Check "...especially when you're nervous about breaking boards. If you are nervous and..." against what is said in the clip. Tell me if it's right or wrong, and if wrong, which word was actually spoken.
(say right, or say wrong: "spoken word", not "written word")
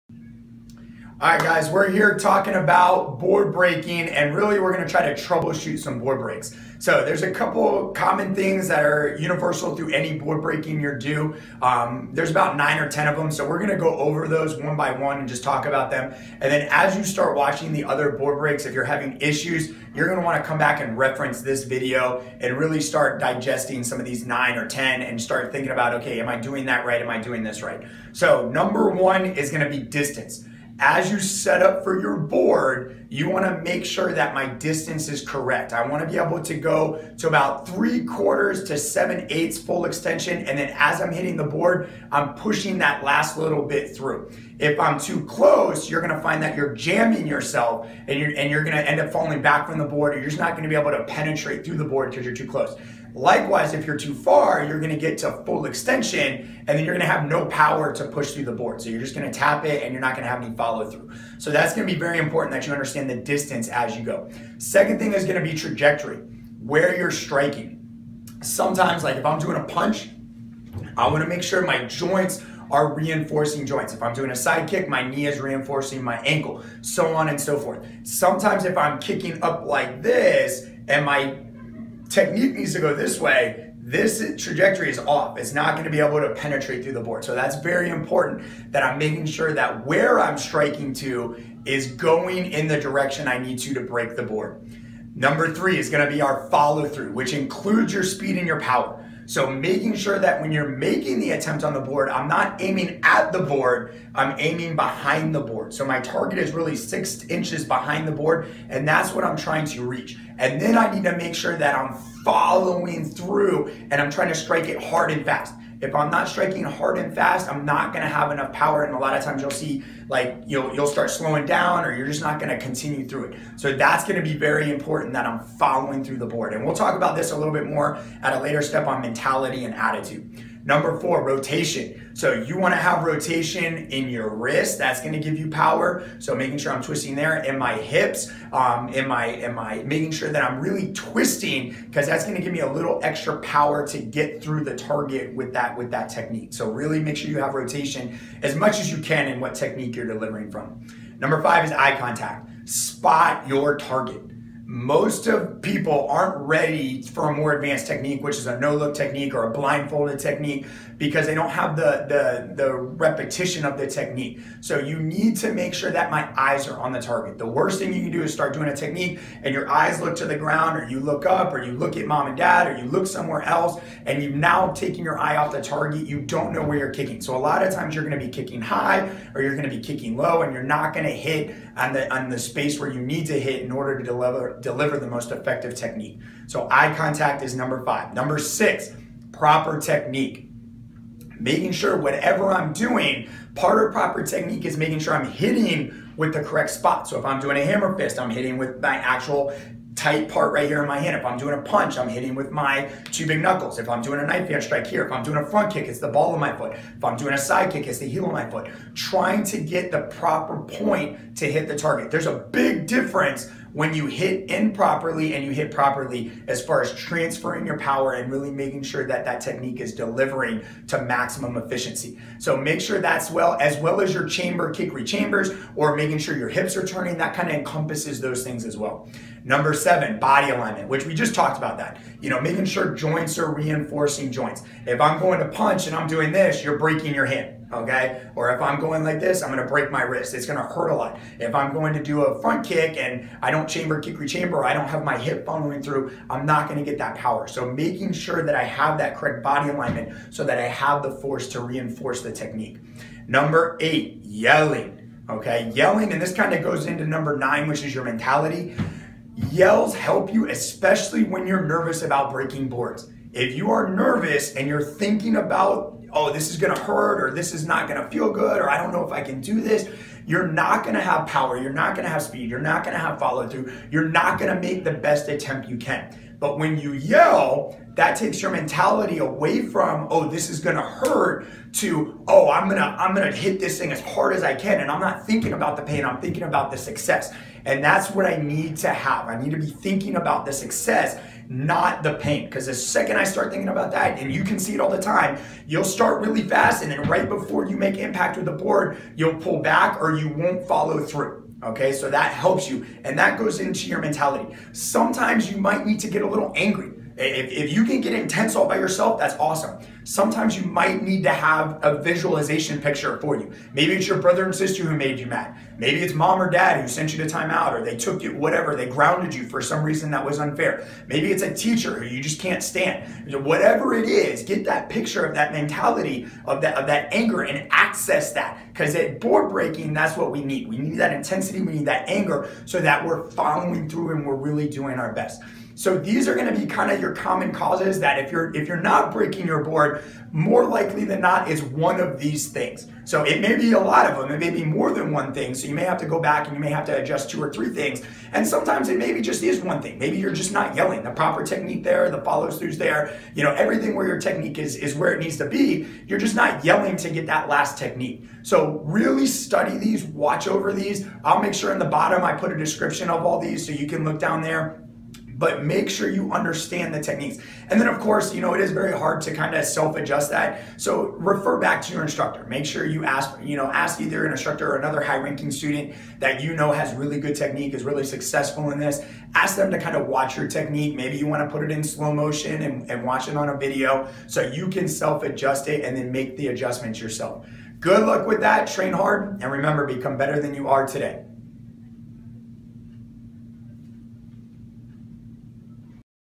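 right.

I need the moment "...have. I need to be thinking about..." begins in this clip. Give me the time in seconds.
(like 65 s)
288 s.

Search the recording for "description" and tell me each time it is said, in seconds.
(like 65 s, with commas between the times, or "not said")
362 s.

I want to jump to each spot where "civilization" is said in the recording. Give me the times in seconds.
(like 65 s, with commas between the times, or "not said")
not said.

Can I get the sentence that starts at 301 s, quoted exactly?
Okay, so that helps you, and that goes into your mentality.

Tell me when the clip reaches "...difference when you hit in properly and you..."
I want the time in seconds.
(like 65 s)
212 s.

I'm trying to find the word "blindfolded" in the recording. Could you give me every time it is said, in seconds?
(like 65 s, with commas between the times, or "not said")
159 s.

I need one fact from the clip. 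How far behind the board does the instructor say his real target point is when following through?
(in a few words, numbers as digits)
6 inches.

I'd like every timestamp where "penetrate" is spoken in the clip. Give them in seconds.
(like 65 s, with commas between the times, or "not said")
51 s, 86 s.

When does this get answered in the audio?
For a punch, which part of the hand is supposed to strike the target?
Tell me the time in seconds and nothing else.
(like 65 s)
203 s.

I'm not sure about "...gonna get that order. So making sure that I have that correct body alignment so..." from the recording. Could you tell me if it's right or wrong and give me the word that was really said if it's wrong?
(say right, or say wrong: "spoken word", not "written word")
wrong: "power", not "order".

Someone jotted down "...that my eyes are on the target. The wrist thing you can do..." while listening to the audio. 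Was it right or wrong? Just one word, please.
wrong.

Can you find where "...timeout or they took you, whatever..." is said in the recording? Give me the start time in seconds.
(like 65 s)
317 s.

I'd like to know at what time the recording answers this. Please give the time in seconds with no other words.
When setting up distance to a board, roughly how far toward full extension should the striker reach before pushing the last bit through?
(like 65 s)
37 s.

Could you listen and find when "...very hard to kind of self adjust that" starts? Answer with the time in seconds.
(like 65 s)
368 s.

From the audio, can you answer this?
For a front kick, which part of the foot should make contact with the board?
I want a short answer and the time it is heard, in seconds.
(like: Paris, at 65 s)
ball of my foot, at 206 s.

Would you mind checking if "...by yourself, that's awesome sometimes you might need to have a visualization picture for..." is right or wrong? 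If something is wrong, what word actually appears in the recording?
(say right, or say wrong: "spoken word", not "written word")
right.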